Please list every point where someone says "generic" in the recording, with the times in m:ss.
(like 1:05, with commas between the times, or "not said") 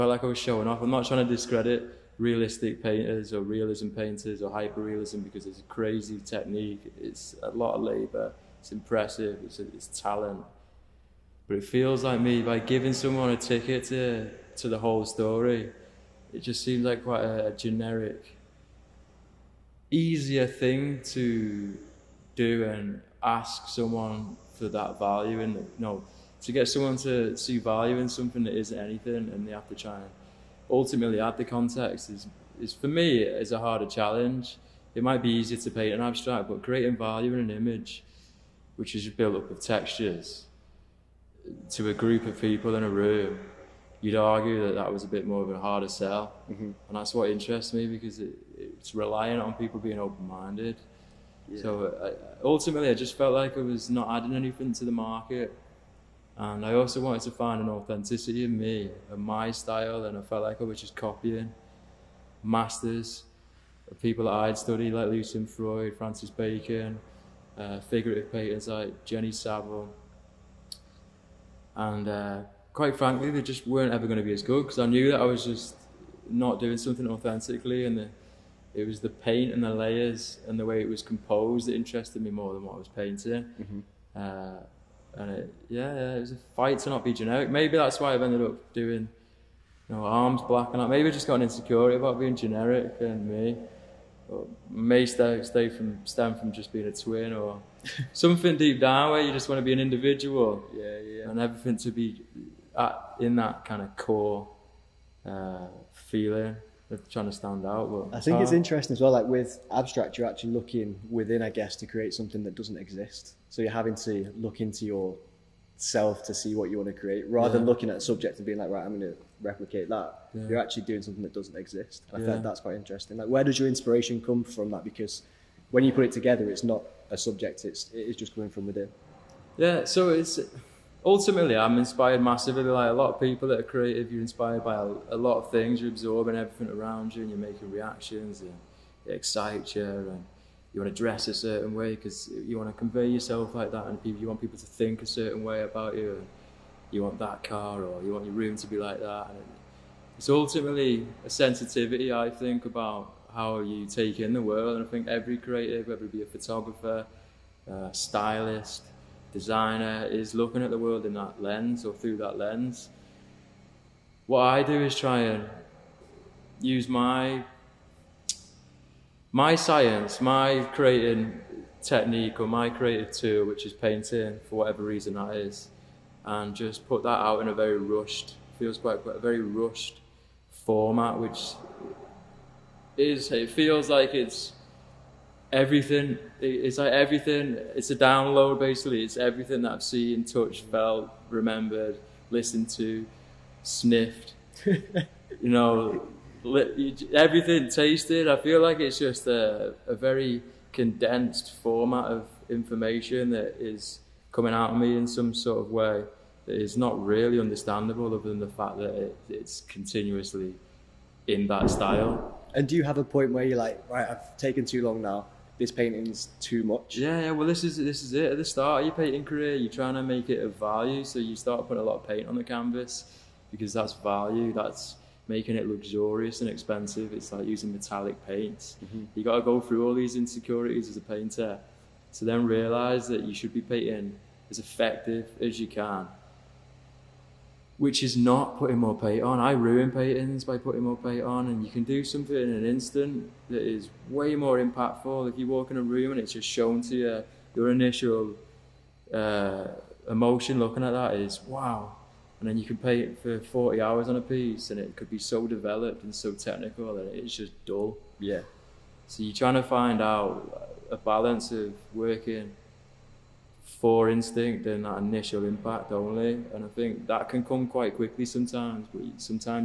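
0:17, 1:27, 1:32.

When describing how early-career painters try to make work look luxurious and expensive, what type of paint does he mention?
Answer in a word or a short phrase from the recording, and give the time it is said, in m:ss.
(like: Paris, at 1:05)
Metallic paints, at 3:47.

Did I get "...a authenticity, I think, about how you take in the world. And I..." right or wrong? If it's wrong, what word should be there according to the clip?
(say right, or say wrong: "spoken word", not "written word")
wrong: "sensitivity", not "authenticity".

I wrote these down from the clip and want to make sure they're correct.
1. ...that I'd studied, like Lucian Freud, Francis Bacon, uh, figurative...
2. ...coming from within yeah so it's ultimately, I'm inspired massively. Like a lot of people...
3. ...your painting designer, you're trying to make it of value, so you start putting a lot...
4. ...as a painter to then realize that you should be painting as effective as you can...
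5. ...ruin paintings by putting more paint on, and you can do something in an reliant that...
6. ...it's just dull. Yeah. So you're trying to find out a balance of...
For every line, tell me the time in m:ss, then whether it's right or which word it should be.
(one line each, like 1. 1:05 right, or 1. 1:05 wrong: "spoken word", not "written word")
1. 1:04 right
2. 2:08 right
3. 3:38 wrong: "career", not "designer"
4. 3:50 right
5. 3:59 wrong: "instant", not "reliant"
6. 4:17 right.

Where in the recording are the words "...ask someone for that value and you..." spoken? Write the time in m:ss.
0:23.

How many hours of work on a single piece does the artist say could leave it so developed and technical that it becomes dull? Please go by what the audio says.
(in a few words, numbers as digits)
40.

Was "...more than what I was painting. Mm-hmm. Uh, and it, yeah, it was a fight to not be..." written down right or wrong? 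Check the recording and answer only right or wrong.
right.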